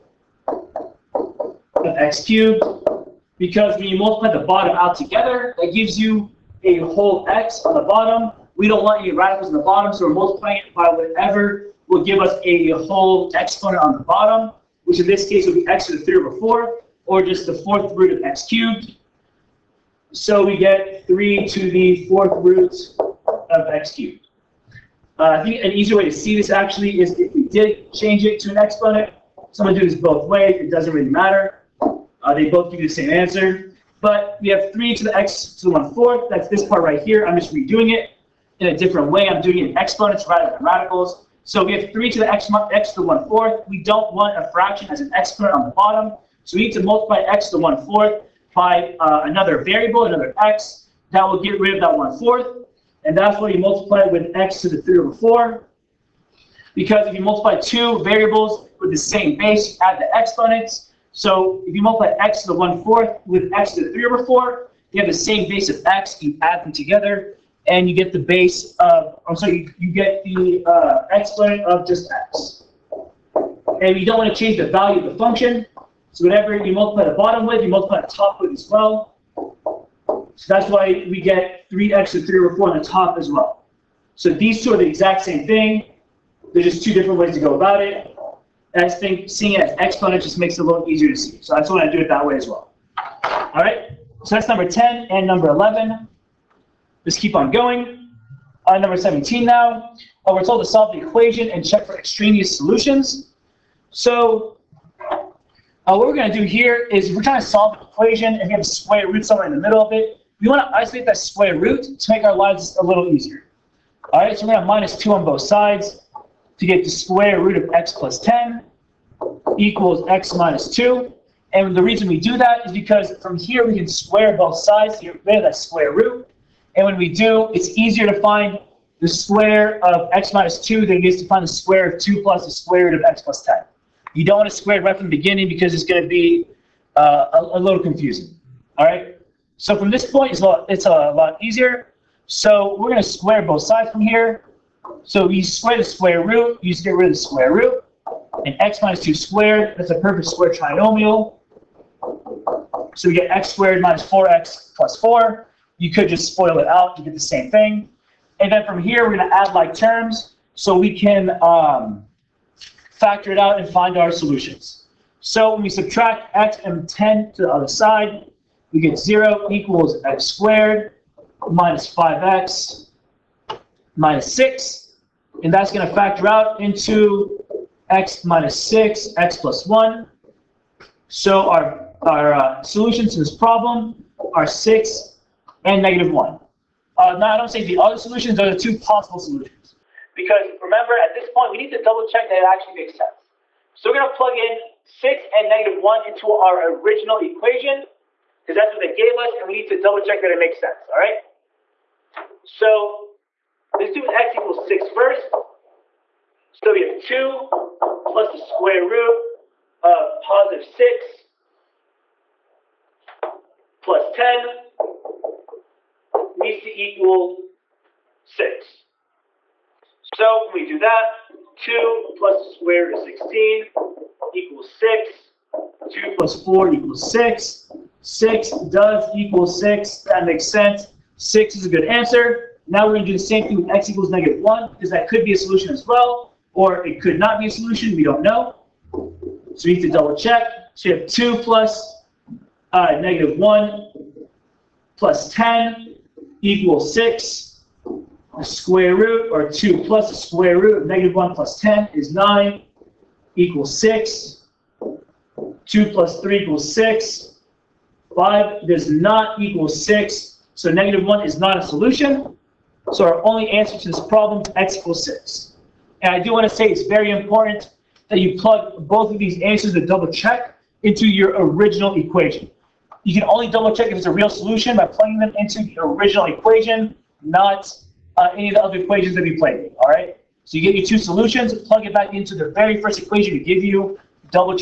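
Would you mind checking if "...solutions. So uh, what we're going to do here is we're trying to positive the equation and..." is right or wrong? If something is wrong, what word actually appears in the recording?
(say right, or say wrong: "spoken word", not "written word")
wrong: "solve", not "positive".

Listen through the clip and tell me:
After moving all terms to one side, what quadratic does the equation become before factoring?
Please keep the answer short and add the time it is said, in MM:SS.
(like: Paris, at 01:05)
x^2 - 5x - 6, at 02:50.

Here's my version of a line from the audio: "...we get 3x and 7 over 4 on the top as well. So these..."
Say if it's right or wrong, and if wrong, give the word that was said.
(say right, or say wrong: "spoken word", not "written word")
wrong: "3", not "7".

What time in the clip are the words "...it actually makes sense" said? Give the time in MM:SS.
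03:12.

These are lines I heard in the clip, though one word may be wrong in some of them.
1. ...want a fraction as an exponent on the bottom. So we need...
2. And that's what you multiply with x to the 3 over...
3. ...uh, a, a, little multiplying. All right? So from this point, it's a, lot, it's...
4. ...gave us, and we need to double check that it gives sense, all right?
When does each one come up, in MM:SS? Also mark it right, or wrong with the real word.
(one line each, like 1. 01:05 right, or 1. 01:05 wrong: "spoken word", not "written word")
1. 00:44 right
2. 00:53 right
3. 02:16 wrong: "confusing", not "multiplying"
4. 03:18 wrong: "makes", not "gives".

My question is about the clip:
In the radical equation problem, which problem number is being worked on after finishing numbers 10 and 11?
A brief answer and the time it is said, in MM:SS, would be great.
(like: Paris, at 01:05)
17, at 01:38.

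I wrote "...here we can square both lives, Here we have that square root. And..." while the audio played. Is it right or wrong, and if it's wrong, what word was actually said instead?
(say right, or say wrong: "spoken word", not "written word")
wrong: "sides", not "lives".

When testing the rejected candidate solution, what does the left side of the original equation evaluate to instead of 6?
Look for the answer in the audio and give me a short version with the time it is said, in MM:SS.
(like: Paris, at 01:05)
5, at 04:18.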